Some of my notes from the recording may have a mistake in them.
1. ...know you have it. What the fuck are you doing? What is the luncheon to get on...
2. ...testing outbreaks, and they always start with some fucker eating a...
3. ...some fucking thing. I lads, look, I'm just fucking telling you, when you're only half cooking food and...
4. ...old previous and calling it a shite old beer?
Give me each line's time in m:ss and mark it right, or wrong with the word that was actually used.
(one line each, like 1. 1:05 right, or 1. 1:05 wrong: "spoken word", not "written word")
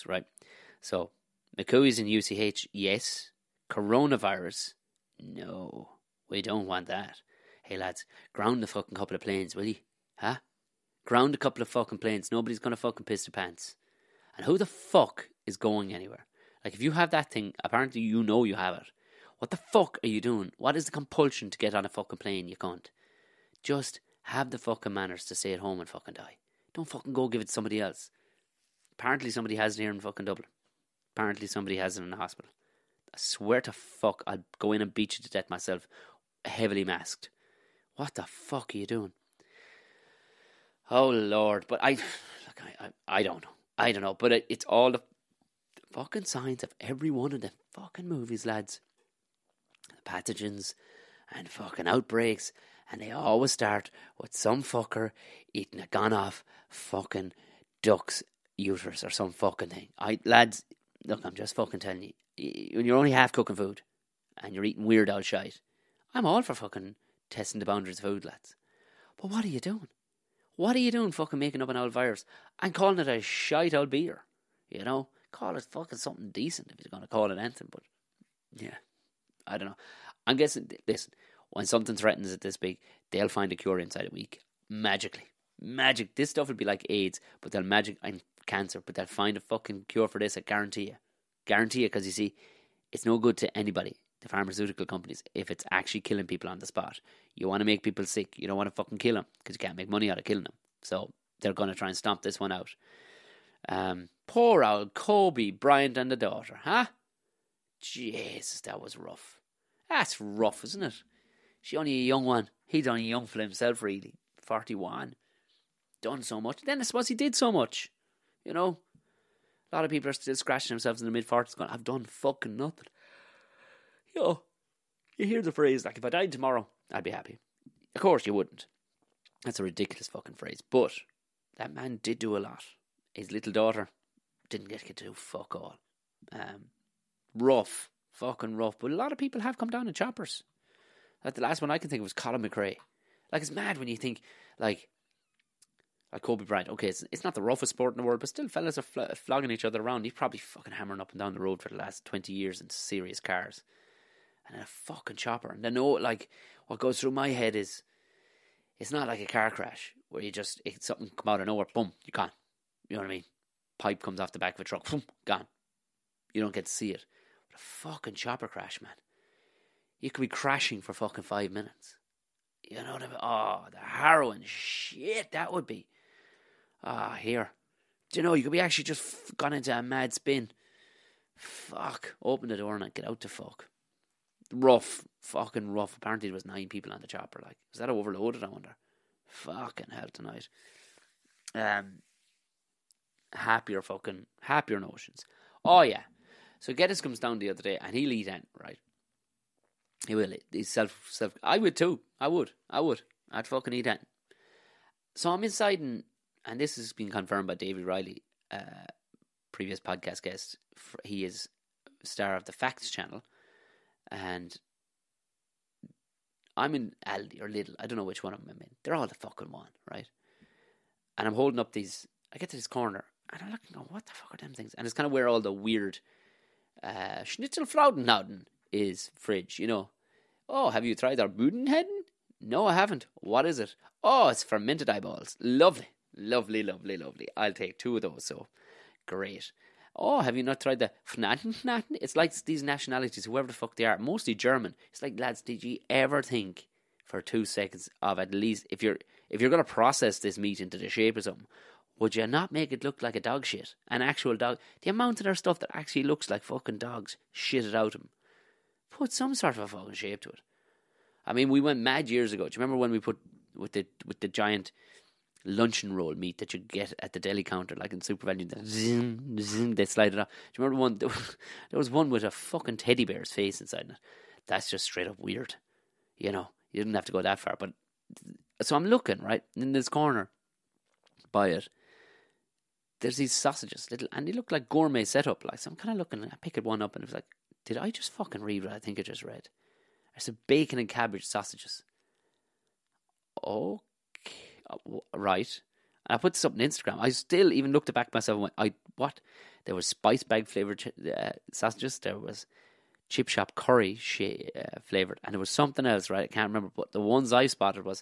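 1. 0:18 wrong: "compulsion", not "luncheon"
2. 0:51 wrong: "fucking", not "testing"
3. 0:59 right
4. 1:11 wrong: "virus", not "previous".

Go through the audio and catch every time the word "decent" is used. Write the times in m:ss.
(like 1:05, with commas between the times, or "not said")
1:16.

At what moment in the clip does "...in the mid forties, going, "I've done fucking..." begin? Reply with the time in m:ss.
2:01.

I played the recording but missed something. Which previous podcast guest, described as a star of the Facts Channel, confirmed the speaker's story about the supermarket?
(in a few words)
David Riley.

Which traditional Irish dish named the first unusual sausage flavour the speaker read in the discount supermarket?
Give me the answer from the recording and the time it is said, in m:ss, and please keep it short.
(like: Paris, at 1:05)
Bacon and cabbage, at 4:50.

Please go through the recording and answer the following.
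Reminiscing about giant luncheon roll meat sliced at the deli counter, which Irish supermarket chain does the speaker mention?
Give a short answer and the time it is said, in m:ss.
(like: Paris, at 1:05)
SuperValu, at 4:28.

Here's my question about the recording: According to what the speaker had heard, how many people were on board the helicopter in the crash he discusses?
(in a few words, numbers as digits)
9.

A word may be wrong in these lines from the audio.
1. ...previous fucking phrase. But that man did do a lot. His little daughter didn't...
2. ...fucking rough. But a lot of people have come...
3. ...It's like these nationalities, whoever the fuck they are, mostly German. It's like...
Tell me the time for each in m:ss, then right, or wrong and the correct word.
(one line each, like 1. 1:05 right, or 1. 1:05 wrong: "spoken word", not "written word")
1. 2:09 wrong: "ridiculous", not "previous"
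2. 2:18 right
3. 4:02 right.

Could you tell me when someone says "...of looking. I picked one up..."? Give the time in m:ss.
4:45.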